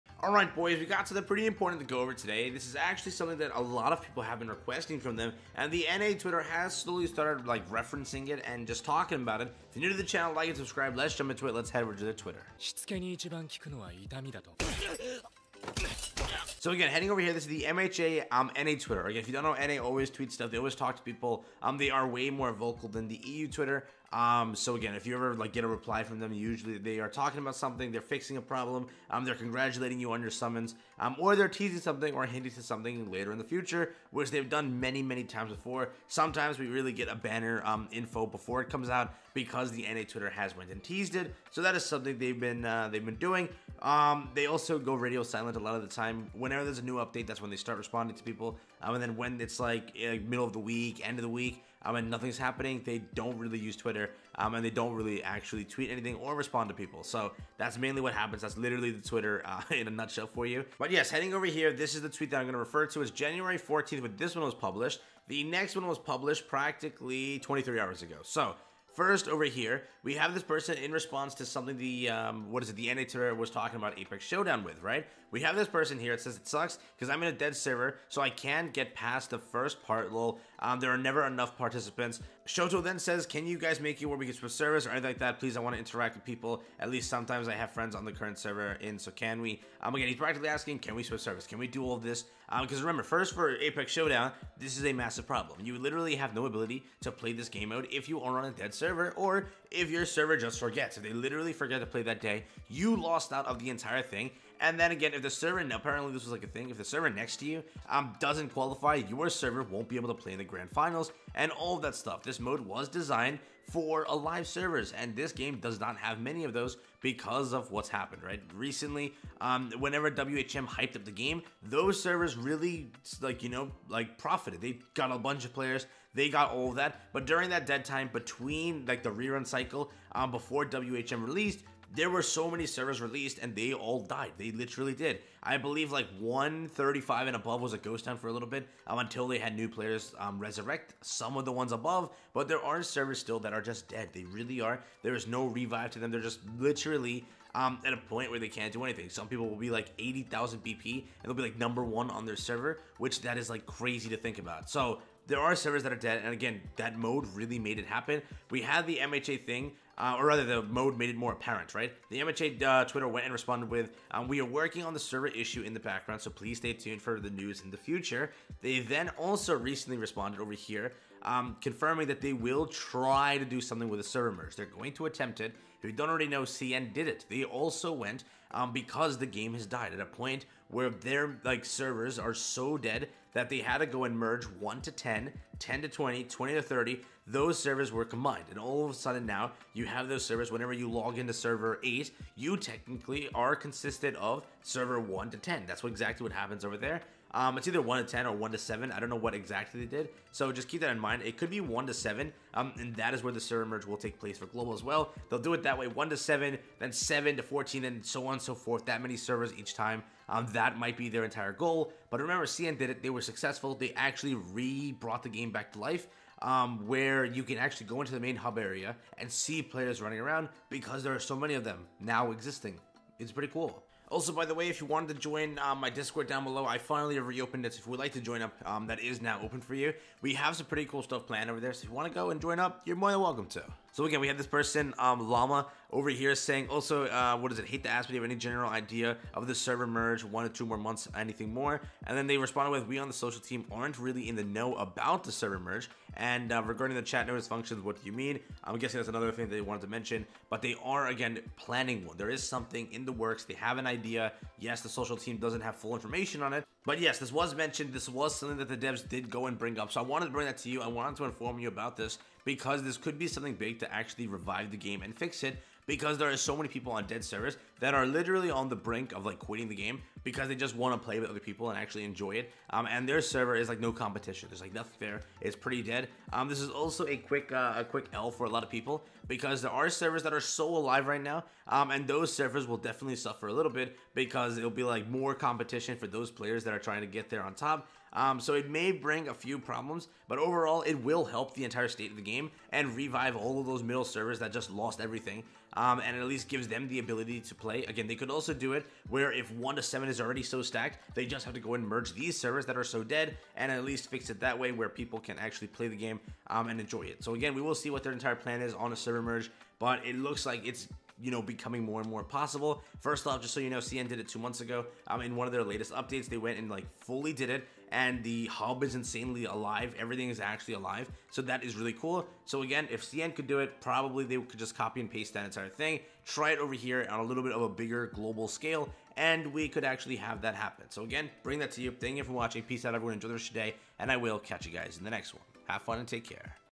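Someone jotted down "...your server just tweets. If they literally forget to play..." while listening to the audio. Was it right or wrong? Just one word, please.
wrong.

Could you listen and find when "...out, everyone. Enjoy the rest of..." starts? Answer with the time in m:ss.
5:32.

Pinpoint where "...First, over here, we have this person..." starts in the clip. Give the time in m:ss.
1:08.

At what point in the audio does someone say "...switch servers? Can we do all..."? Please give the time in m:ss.
1:31.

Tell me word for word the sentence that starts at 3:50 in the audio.
We have some pretty cool stuff planned over there.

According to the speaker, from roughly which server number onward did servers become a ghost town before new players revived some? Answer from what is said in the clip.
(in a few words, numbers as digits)
135.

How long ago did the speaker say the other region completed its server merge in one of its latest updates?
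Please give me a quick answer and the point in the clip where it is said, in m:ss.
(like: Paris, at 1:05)
2 months, at 5:14.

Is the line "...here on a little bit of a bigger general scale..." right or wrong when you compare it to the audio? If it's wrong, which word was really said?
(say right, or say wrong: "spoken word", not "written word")
wrong: "global", not "general".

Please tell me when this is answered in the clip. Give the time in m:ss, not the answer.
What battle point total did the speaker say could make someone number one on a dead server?
2:29.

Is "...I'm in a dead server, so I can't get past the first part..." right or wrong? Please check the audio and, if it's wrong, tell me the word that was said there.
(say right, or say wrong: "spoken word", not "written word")
right.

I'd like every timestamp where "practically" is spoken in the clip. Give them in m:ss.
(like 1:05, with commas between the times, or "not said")
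1:06, 1:30.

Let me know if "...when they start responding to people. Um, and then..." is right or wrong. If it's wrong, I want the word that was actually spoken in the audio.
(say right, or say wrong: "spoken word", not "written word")
right.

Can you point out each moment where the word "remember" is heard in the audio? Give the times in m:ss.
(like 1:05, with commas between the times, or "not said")
1:32, 3:32.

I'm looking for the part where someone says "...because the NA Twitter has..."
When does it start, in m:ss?
0:39.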